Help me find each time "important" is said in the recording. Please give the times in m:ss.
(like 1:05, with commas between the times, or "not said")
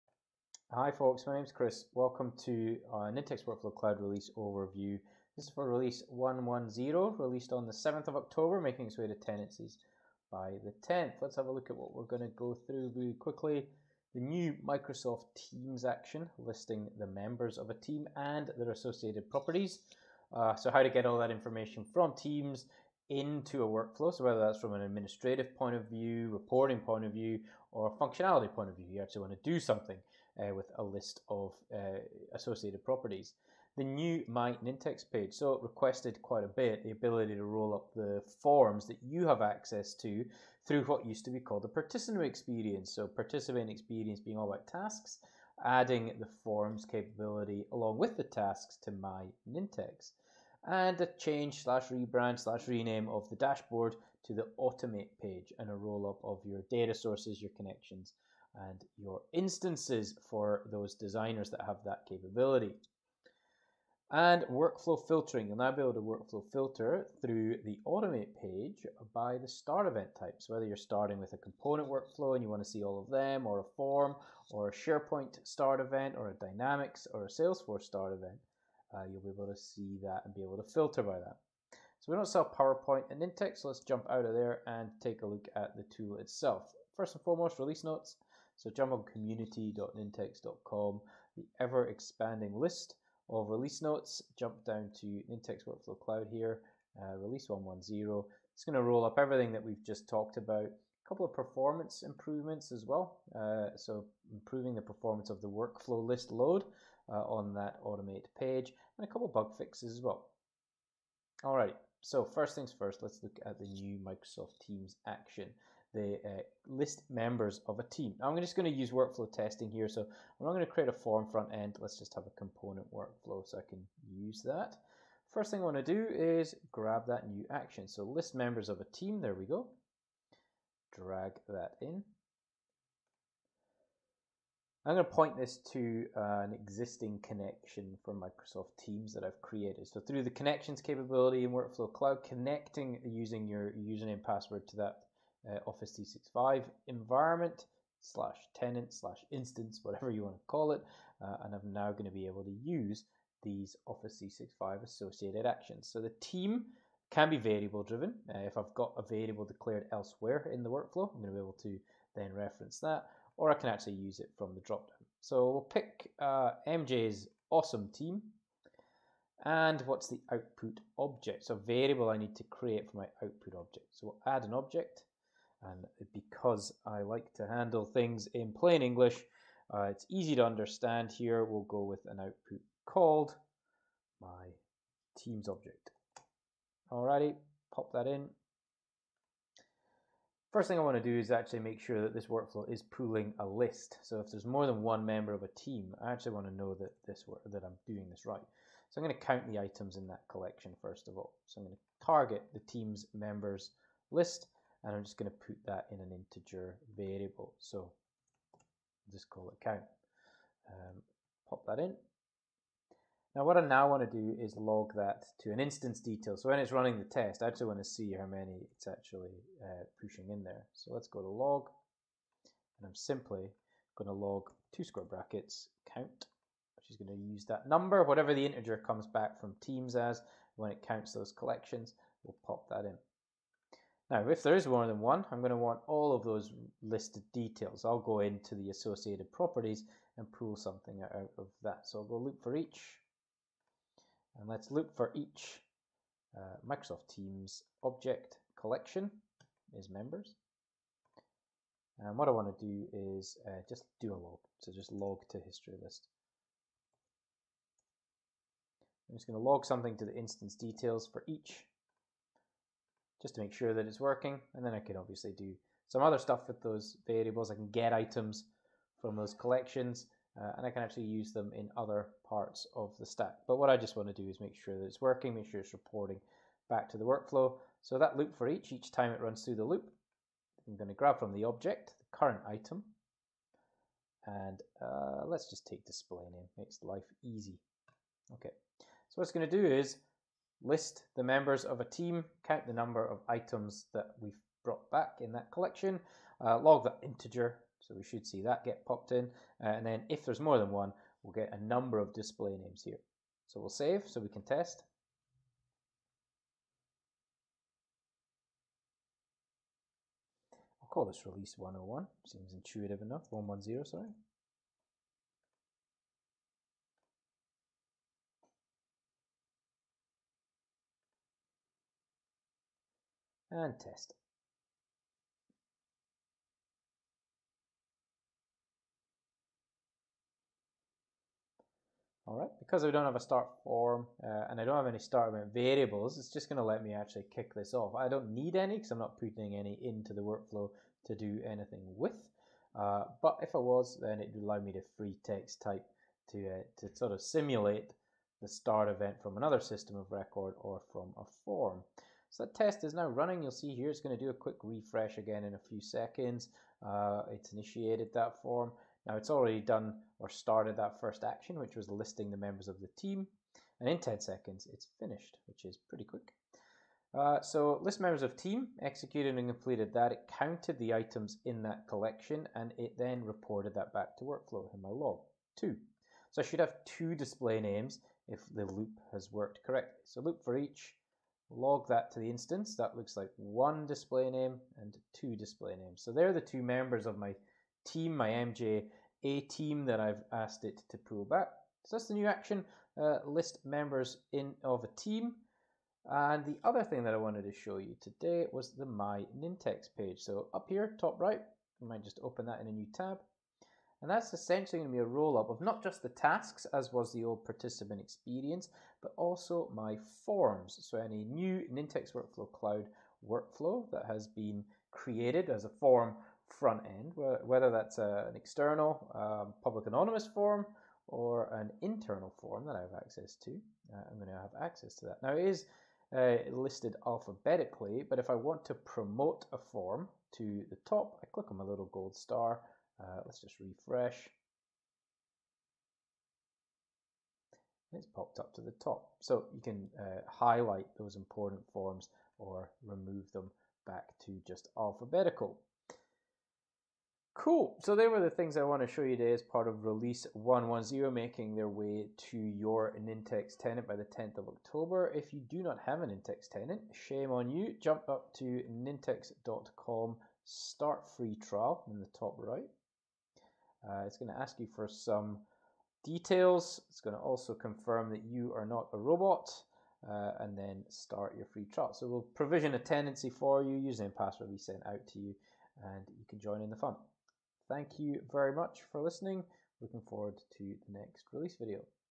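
7:21.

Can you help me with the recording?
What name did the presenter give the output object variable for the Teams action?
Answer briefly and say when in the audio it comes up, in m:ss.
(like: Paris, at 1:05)
my Teams object, at 3:04.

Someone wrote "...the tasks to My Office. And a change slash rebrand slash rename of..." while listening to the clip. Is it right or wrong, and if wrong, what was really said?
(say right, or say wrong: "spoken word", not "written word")
wrong: "Nintex", not "Office".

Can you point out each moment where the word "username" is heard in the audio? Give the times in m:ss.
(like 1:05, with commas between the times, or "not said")
2:23, 7:53.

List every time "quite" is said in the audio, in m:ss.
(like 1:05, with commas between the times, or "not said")
0:36.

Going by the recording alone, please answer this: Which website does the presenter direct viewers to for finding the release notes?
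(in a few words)
community.nintex.com.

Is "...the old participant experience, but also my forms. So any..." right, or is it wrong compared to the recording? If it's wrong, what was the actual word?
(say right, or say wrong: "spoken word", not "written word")
right.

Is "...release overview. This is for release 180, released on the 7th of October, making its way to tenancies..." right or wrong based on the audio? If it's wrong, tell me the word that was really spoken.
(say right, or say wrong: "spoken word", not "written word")
wrong: "110", not "180".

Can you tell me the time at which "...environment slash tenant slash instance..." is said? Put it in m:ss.
2:26.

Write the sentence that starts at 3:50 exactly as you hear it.
When it counts those collections, we'll pop that in.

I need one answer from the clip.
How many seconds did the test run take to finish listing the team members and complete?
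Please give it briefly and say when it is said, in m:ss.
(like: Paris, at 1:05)
10, at 6:03.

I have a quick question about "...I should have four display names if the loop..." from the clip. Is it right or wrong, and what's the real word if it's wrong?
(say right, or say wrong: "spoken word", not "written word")
wrong: "two", not "four".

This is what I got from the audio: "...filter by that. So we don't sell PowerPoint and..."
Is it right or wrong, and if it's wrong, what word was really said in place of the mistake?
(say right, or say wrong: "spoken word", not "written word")
right.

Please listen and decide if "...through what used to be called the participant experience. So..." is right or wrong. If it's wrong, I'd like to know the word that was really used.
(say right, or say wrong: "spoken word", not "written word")
right.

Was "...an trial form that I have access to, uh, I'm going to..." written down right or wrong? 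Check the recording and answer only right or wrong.
wrong.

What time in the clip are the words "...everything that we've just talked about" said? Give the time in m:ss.
1:39.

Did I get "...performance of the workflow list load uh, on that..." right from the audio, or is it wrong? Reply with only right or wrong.
right.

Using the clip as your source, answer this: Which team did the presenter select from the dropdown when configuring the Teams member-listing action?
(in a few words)
MJ's awesome team.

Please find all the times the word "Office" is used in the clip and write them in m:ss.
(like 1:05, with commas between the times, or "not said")
2:25, 2:33.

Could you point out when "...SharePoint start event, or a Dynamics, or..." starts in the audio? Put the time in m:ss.
1:14.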